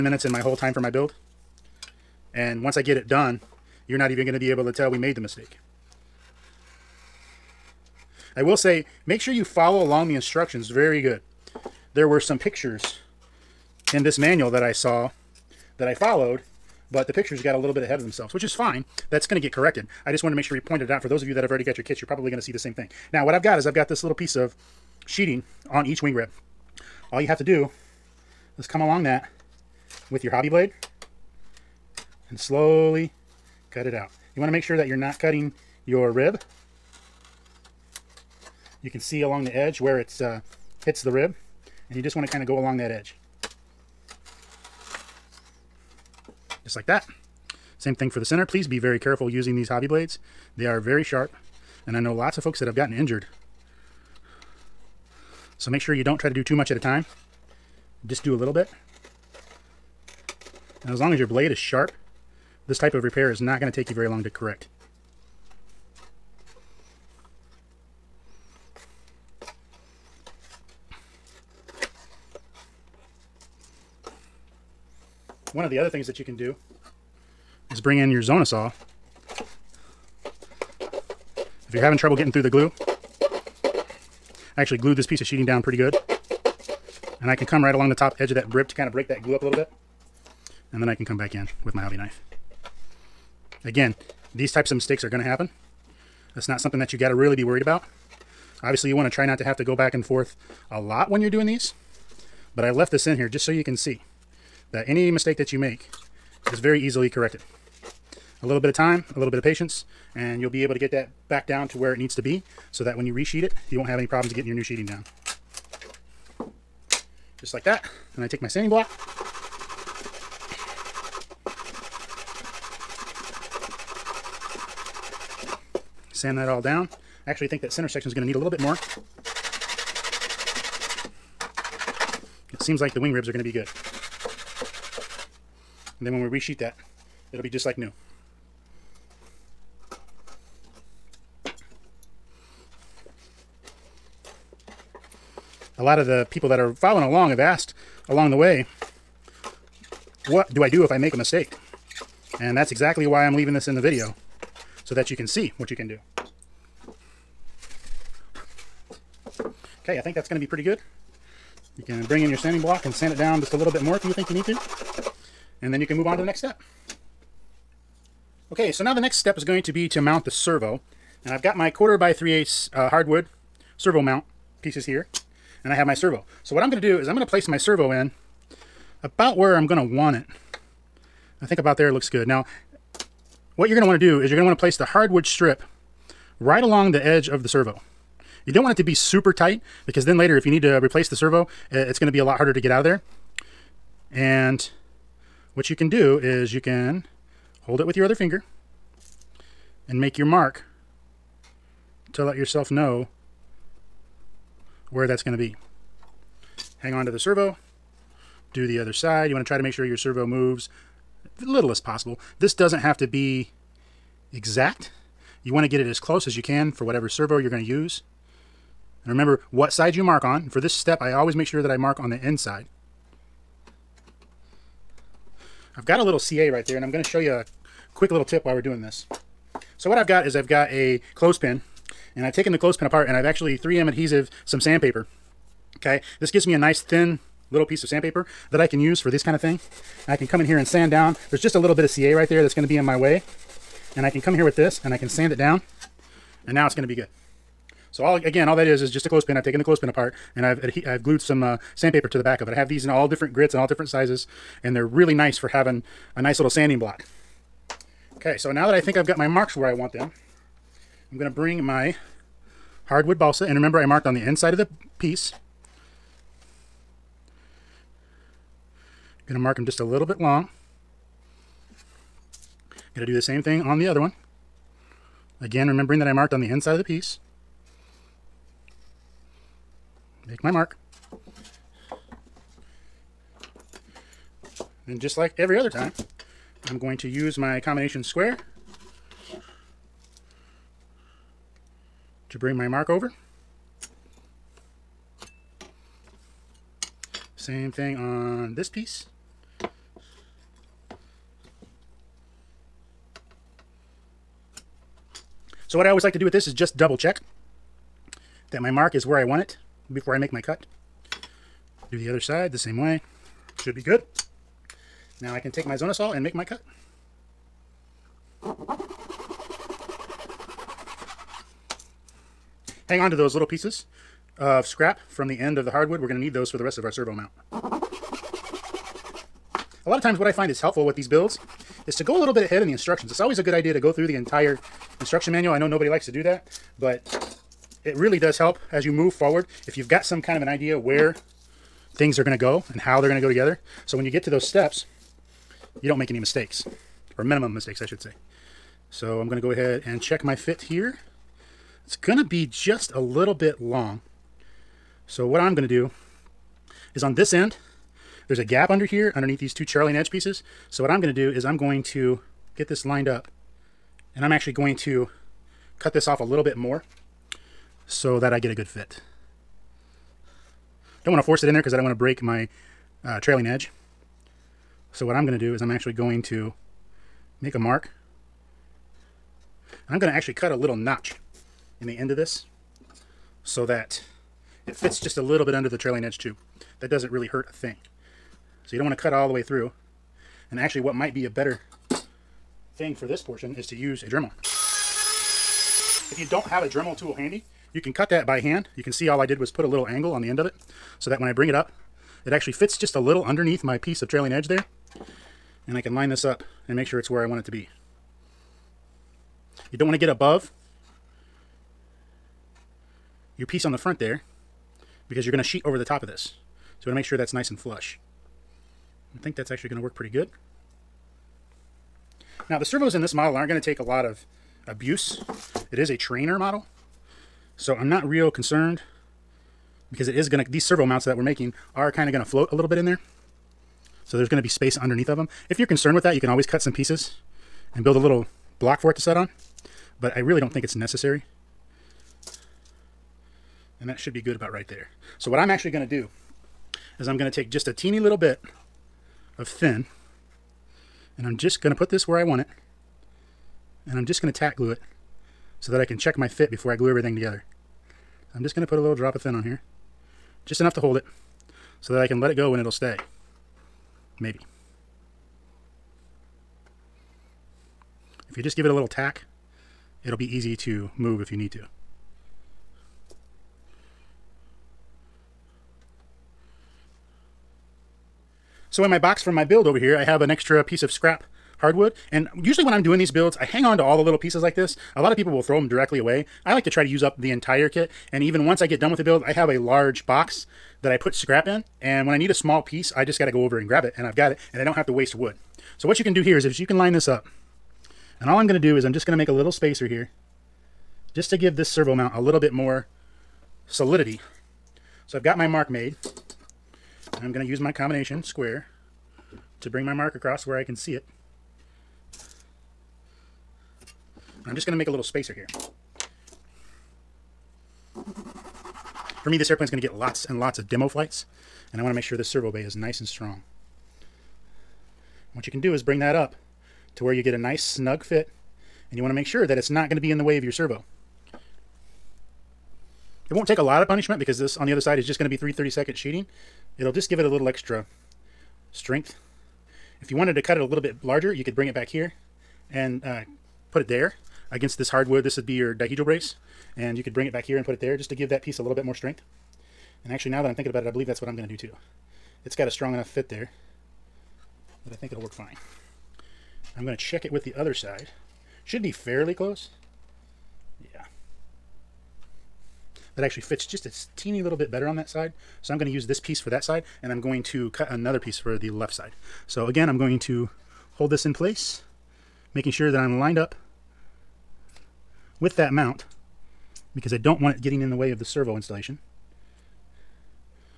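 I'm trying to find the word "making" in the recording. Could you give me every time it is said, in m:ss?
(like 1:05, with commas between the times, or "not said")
7:11, 9:32.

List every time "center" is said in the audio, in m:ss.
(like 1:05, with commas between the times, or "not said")
0:48, 2:07.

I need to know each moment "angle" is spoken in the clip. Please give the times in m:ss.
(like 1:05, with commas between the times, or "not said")
6:39.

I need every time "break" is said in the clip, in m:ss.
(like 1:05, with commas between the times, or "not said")
1:28, 6:11.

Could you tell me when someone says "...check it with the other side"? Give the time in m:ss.
9:16.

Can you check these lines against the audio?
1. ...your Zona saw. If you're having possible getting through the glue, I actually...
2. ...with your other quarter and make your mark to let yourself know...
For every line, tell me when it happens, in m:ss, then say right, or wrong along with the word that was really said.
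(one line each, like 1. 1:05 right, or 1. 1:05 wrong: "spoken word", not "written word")
1. 1:18 wrong: "trouble", not "possible"
2. 3:17 wrong: "finger", not "quarter".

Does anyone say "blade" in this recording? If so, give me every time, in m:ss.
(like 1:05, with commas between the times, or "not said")
0:30, 0:49, 1:01.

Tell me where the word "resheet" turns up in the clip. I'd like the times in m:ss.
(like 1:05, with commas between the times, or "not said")
1:53, 2:16.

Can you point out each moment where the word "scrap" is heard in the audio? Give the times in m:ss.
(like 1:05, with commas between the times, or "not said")
5:24, 8:00, 8:11.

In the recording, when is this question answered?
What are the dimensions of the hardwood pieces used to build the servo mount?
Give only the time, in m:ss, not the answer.
2:51.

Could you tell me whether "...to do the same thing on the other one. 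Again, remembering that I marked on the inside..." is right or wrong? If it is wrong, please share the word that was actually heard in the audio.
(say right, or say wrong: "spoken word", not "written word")
right.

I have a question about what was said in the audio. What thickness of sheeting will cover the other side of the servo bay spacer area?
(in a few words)
3/32.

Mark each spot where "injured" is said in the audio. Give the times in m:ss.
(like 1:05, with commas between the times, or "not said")
0:52.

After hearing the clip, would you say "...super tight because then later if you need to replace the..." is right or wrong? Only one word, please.
right.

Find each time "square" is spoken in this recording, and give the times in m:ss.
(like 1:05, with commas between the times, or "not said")
4:48, 8:28.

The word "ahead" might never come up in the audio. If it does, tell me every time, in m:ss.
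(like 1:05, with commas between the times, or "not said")
0:17, 5:32, 5:49.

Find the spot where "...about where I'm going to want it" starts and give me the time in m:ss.
2:59.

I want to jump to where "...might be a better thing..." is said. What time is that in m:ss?
6:30.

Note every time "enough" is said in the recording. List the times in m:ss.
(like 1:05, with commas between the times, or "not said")
7:40, 9:12.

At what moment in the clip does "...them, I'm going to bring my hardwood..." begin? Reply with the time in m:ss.
4:19.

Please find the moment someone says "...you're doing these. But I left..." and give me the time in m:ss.
1:41.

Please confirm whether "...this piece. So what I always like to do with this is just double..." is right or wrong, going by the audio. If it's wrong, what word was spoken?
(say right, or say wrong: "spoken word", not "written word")
right.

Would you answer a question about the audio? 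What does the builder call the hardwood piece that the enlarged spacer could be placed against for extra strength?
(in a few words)
dihedral brace.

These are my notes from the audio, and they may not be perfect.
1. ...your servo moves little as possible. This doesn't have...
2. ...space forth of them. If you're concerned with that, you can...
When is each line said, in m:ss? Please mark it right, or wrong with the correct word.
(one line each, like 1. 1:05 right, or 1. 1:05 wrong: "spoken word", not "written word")
1. 3:29 right
2. 7:14 wrong: "underneath", not "forth".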